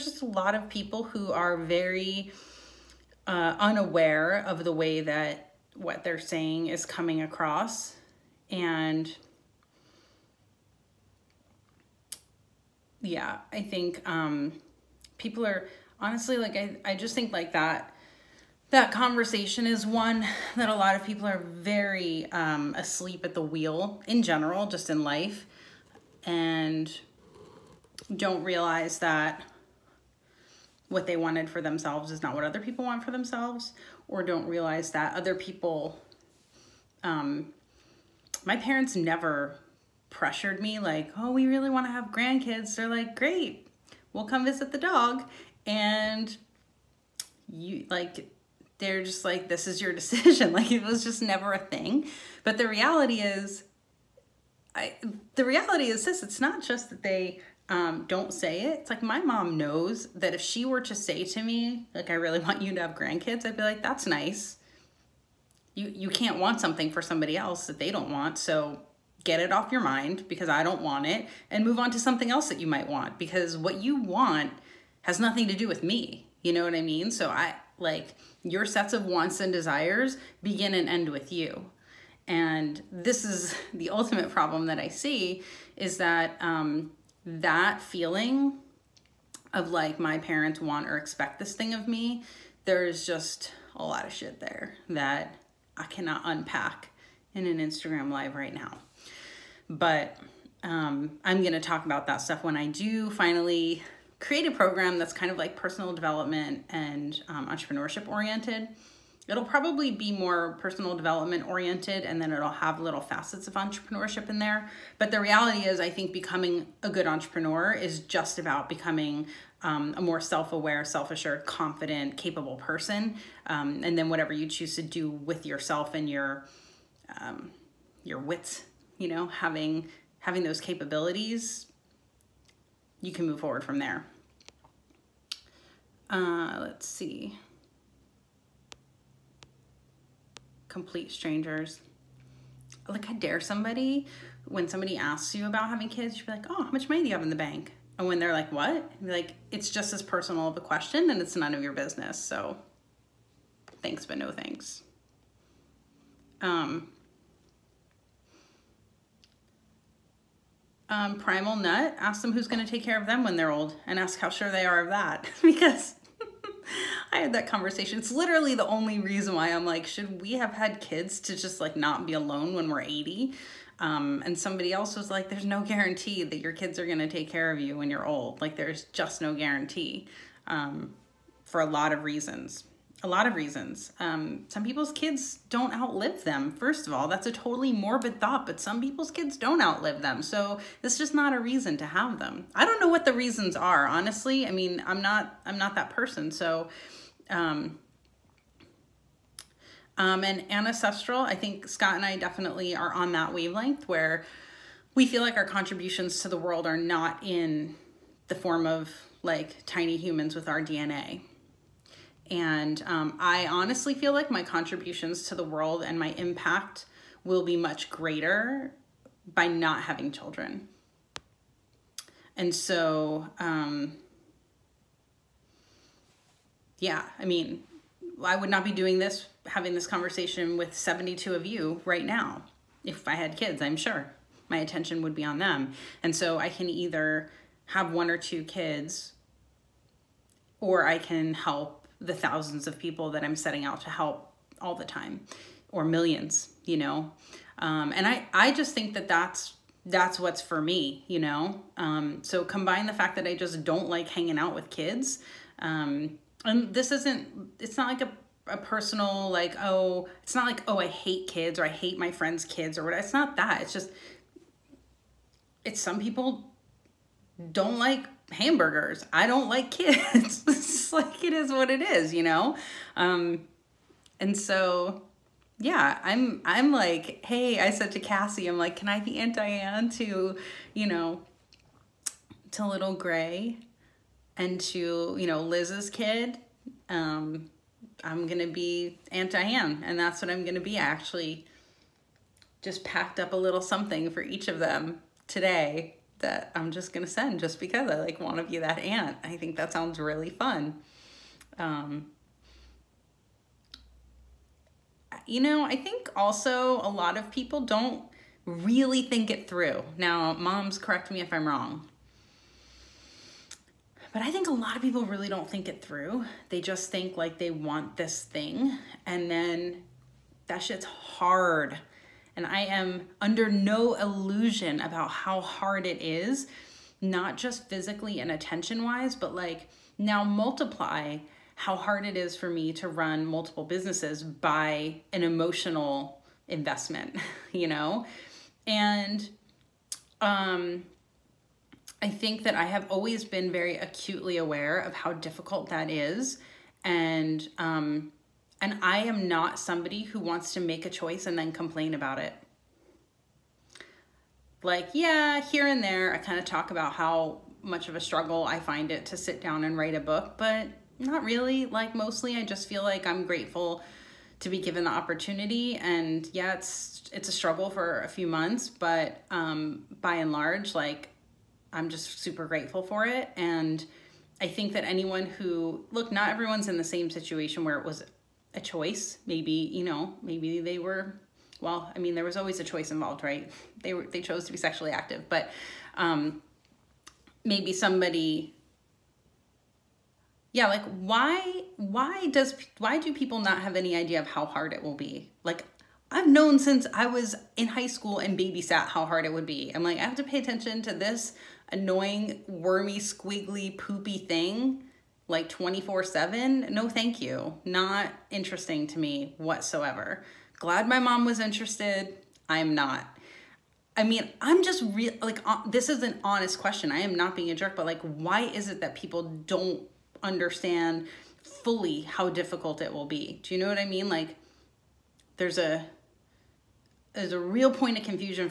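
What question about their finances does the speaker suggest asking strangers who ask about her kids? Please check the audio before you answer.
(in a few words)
How much money do you have in the bank.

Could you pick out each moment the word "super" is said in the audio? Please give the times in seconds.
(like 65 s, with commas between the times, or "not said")
372 s.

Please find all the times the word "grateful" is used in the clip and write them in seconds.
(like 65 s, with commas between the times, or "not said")
363 s, 372 s.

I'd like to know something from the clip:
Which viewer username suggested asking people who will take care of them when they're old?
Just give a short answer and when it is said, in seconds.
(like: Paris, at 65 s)
Primal Nut, at 161 s.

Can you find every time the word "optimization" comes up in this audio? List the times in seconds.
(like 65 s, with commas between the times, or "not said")
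not said.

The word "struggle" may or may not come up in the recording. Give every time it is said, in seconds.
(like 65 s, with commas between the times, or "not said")
357 s, 367 s.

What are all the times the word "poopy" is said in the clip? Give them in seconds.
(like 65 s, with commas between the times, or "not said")
403 s.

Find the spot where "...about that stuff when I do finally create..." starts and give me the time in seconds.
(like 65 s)
101 s.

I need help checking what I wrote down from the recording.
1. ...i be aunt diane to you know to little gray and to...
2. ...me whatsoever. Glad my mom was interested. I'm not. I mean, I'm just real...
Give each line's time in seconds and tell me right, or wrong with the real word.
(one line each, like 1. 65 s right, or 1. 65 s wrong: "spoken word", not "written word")
1. 278 s right
2. 408 s right.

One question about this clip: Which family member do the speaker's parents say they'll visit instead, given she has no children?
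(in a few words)
The dog.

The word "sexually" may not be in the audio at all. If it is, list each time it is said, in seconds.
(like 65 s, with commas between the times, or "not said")
384 s.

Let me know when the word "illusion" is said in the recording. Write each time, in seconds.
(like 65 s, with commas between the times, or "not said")
323 s.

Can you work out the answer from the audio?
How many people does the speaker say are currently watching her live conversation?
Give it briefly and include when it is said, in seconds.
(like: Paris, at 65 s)
72, at 230 s.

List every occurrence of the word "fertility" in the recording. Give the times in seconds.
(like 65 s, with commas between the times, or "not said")
not said.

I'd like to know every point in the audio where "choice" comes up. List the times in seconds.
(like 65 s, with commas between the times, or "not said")
350 s, 378 s, 382 s.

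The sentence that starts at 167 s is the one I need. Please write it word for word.
It's literally the only reason why I'm like, should we have had kids to just like not be alone when we're 80?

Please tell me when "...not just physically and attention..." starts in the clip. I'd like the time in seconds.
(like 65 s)
327 s.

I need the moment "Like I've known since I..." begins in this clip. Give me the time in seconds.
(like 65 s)
395 s.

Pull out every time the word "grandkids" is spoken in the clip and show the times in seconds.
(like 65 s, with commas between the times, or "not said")
42 s, 62 s.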